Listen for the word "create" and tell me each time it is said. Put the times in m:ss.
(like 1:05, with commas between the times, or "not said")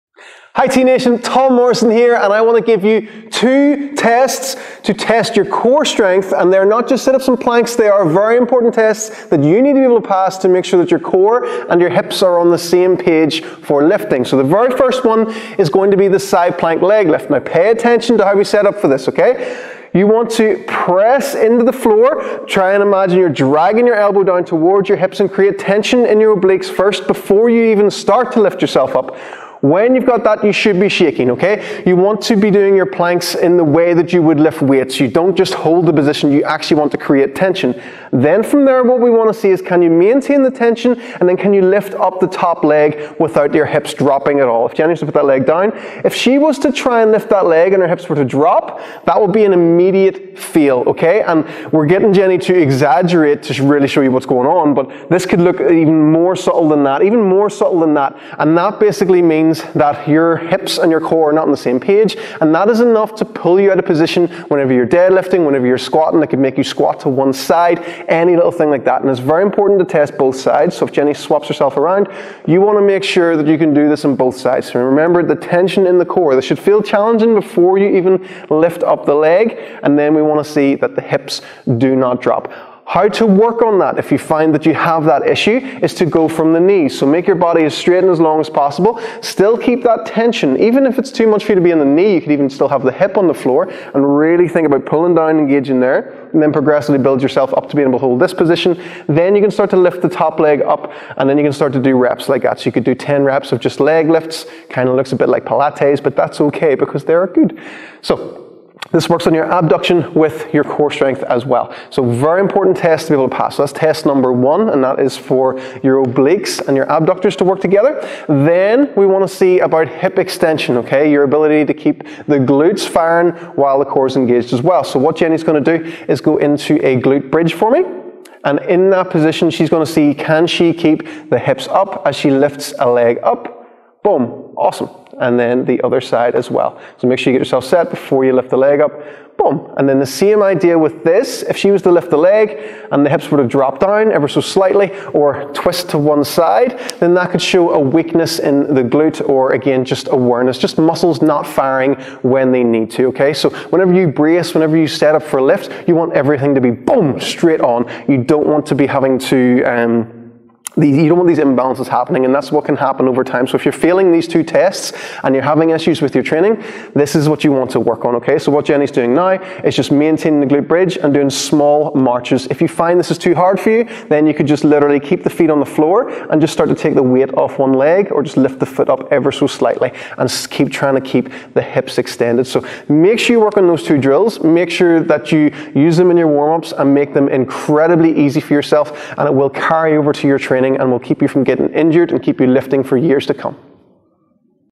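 0:25, 0:36.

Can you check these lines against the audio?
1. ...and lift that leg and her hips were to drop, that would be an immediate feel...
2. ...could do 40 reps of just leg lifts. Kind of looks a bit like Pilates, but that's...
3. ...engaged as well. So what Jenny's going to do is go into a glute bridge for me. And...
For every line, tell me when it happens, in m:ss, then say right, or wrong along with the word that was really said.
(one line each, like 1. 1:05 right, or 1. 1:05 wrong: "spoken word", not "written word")
1. 0:47 right
2. 1:42 wrong: "10", not "40"
3. 2:04 right.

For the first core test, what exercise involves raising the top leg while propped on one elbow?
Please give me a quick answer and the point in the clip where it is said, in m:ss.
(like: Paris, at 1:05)
side plank leg lift, at 0:16.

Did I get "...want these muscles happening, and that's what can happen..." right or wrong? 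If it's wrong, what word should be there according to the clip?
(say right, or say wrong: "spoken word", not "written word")
wrong: "imbalances", not "muscles".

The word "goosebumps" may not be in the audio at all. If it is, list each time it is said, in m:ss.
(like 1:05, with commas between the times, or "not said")
not said.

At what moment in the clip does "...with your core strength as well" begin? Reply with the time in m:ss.
1:50.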